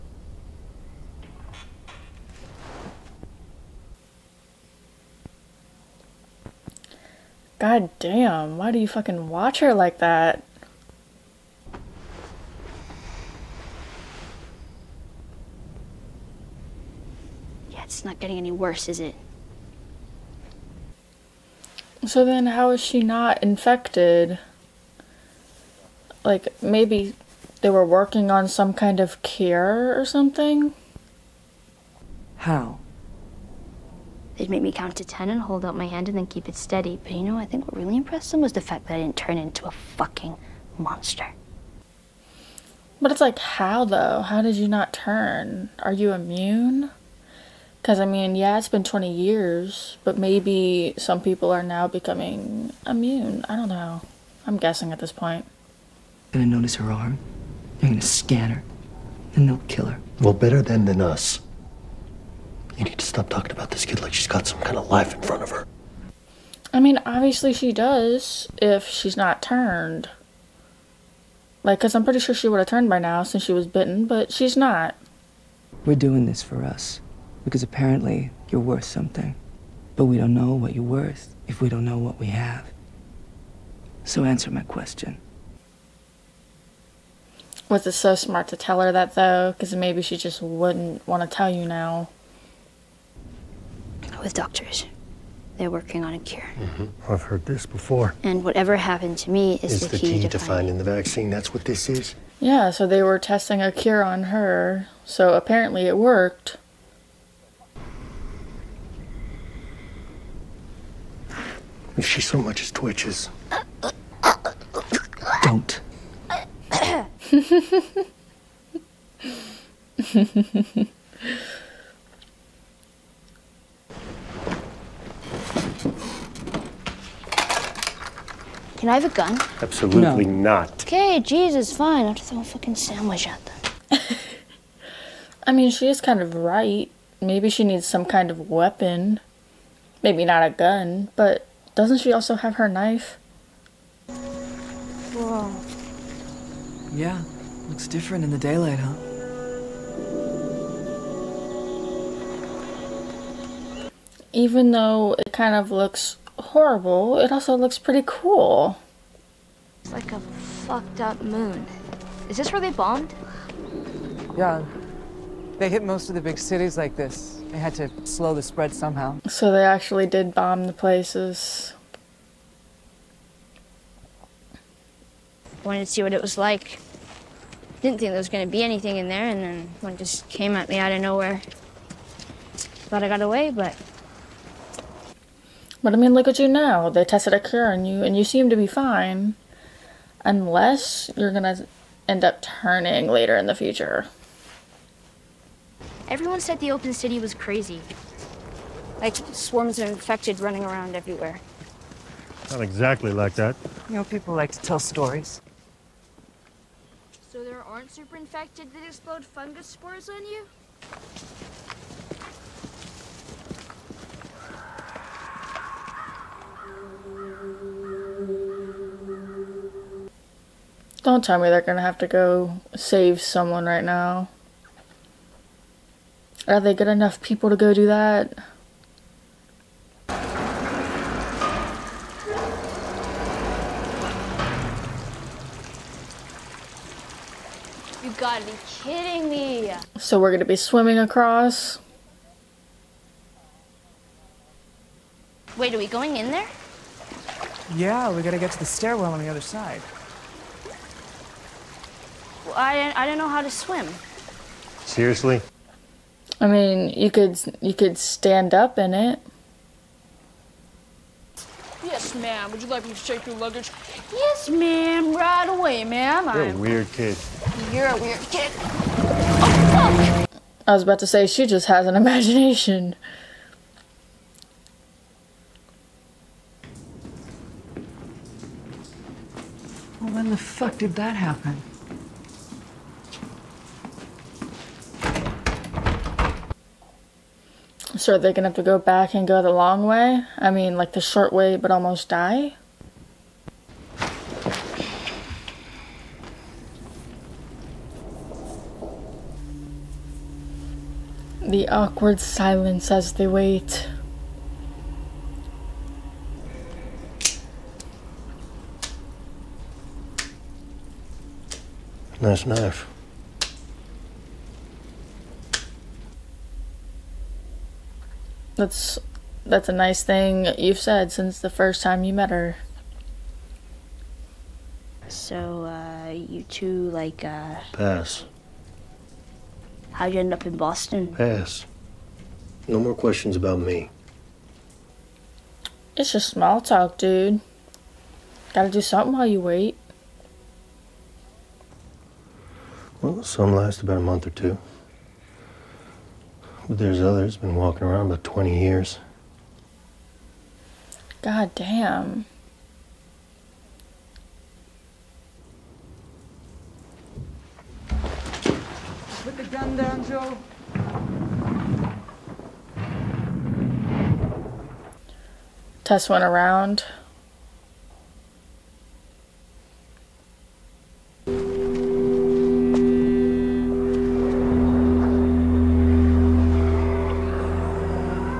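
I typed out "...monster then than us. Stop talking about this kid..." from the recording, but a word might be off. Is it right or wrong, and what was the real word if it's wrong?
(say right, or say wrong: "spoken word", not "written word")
wrong: "better", not "monster".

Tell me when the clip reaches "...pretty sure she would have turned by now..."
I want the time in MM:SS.
01:12.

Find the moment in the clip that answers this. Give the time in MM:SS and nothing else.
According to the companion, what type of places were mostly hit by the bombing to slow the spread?
02:46.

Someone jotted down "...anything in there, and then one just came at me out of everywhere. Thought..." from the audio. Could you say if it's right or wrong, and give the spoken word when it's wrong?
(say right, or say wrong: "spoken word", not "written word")
wrong: "nowhere", not "everywhere".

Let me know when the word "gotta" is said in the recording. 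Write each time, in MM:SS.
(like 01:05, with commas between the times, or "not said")
03:58, 04:08, 05:38.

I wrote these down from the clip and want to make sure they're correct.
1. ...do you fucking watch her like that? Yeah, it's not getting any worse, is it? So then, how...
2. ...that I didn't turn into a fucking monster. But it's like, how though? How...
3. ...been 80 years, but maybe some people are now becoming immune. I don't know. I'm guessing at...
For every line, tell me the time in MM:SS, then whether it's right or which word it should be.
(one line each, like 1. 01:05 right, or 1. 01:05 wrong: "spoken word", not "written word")
1. 00:08 right
2. 00:38 right
3. 00:48 wrong: "20", not "80".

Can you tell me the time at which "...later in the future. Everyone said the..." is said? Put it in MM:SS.
03:13.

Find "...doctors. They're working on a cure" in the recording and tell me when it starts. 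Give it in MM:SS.
01:34.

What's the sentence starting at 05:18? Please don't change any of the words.
That's that's a nice thing you've said since the first time you met her.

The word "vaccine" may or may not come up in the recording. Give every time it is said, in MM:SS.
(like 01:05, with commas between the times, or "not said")
01:40.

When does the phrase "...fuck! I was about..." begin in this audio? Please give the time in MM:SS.
04:30.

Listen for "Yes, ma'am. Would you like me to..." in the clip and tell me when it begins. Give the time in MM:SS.
04:21.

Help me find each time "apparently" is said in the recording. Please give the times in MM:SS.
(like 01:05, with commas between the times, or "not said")
01:17, 01:45.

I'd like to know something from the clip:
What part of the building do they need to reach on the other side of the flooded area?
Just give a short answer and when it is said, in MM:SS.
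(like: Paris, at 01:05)
The stairwell, at 04:08.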